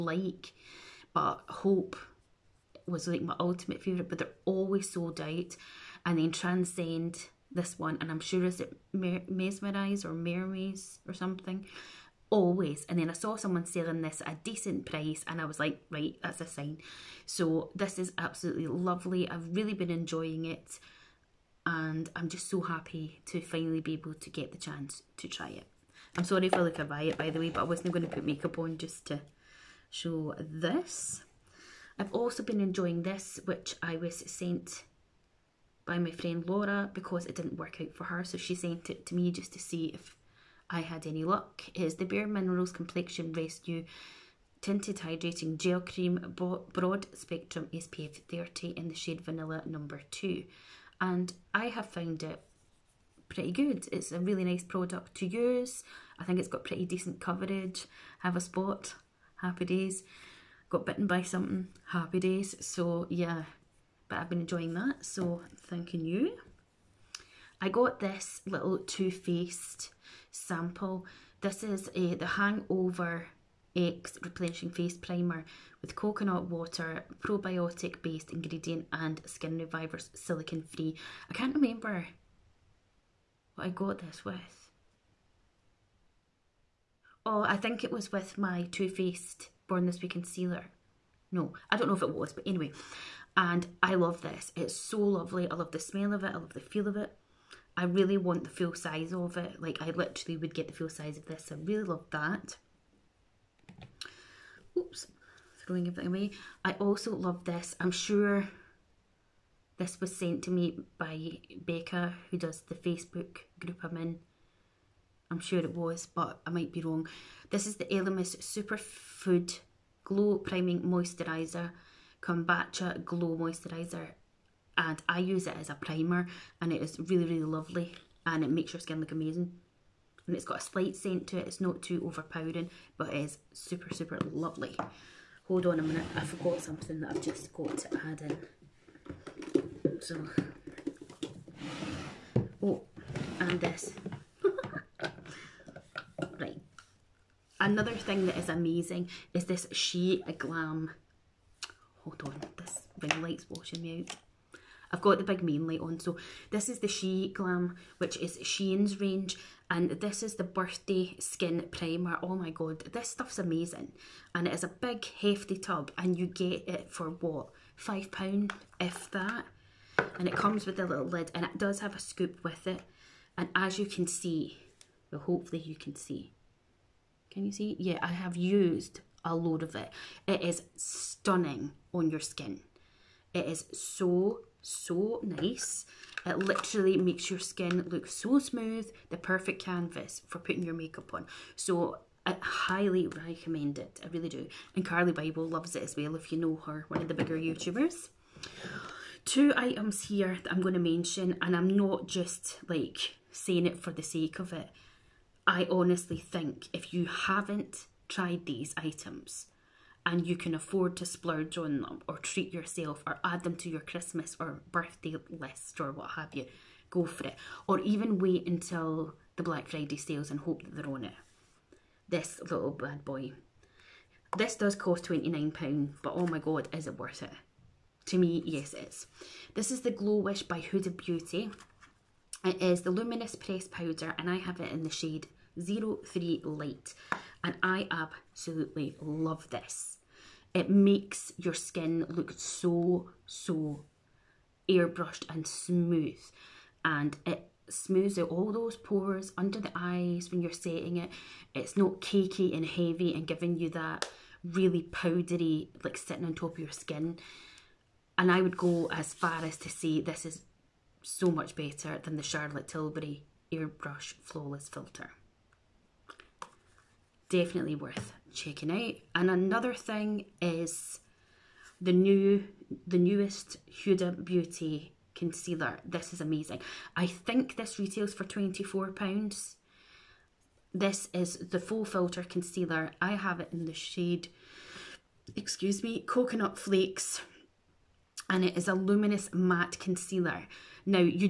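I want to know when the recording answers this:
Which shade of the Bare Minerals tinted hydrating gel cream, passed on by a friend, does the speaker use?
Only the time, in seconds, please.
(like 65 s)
49 s.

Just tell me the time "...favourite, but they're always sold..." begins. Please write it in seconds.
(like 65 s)
3 s.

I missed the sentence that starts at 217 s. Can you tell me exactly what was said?
Or even wait until the Black Friday sales and hope that they're on it.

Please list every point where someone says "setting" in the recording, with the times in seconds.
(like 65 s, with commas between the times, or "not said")
250 s.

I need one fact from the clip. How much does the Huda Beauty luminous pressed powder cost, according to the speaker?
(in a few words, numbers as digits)
£29.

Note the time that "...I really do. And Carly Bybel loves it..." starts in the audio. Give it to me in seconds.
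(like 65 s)
194 s.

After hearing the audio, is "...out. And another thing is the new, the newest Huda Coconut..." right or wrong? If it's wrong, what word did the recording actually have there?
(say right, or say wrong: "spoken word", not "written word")
wrong: "Beauty", not "Coconut".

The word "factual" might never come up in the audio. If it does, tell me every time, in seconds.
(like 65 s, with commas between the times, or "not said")
not said.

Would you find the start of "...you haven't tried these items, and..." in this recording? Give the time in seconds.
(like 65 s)
206 s.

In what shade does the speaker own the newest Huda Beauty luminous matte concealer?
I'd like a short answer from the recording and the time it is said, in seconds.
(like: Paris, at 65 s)
Coconut Flakes, at 286 s.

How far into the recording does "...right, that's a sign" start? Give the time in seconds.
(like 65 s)
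15 s.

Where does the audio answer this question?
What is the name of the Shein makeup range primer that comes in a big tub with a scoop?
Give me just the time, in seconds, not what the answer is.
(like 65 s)
160 s.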